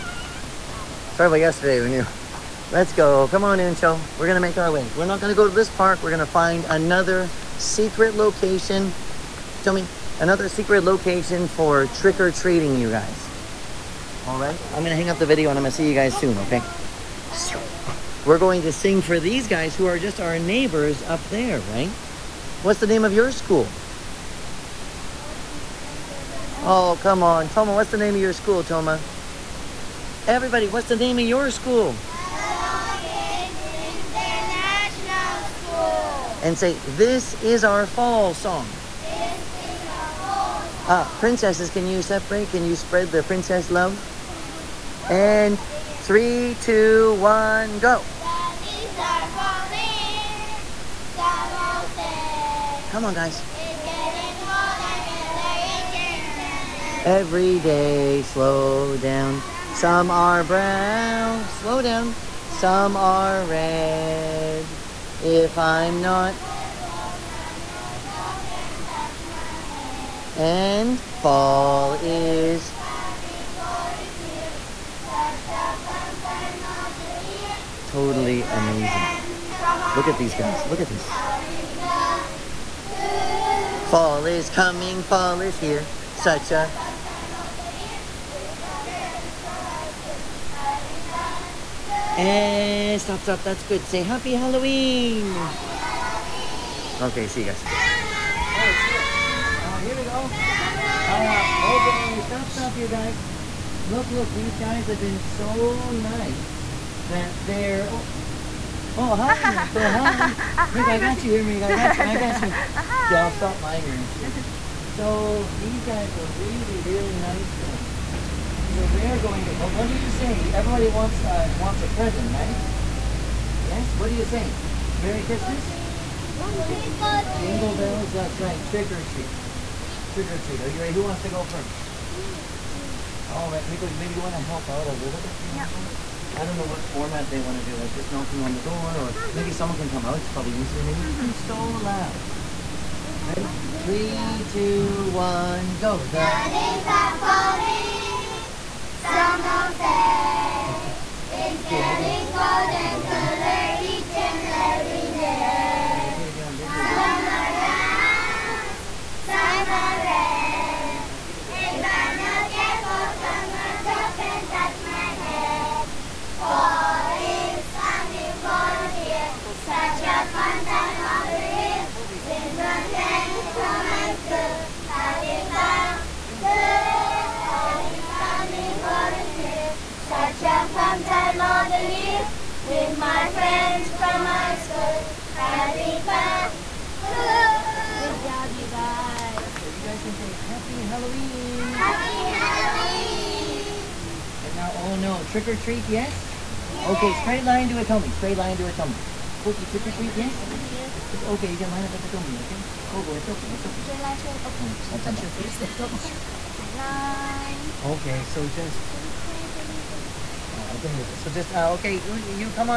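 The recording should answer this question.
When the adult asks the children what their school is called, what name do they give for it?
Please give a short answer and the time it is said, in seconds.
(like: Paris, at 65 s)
International School, at 33 s.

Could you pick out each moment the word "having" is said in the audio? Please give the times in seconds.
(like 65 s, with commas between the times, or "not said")
174 s, 185 s.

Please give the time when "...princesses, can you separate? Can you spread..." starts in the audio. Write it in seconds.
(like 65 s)
41 s.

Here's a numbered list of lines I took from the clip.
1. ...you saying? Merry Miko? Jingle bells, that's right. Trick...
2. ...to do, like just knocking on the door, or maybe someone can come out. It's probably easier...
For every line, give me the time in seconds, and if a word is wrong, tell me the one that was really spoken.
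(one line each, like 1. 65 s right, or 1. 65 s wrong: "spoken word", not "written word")
1. 124 s wrong: "Christmas", not "Miko"
2. 137 s right.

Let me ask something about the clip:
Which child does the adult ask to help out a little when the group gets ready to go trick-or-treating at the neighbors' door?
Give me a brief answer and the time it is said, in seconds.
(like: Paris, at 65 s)
Miko, at 133 s.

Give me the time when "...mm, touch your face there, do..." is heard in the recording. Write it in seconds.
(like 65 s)
204 s.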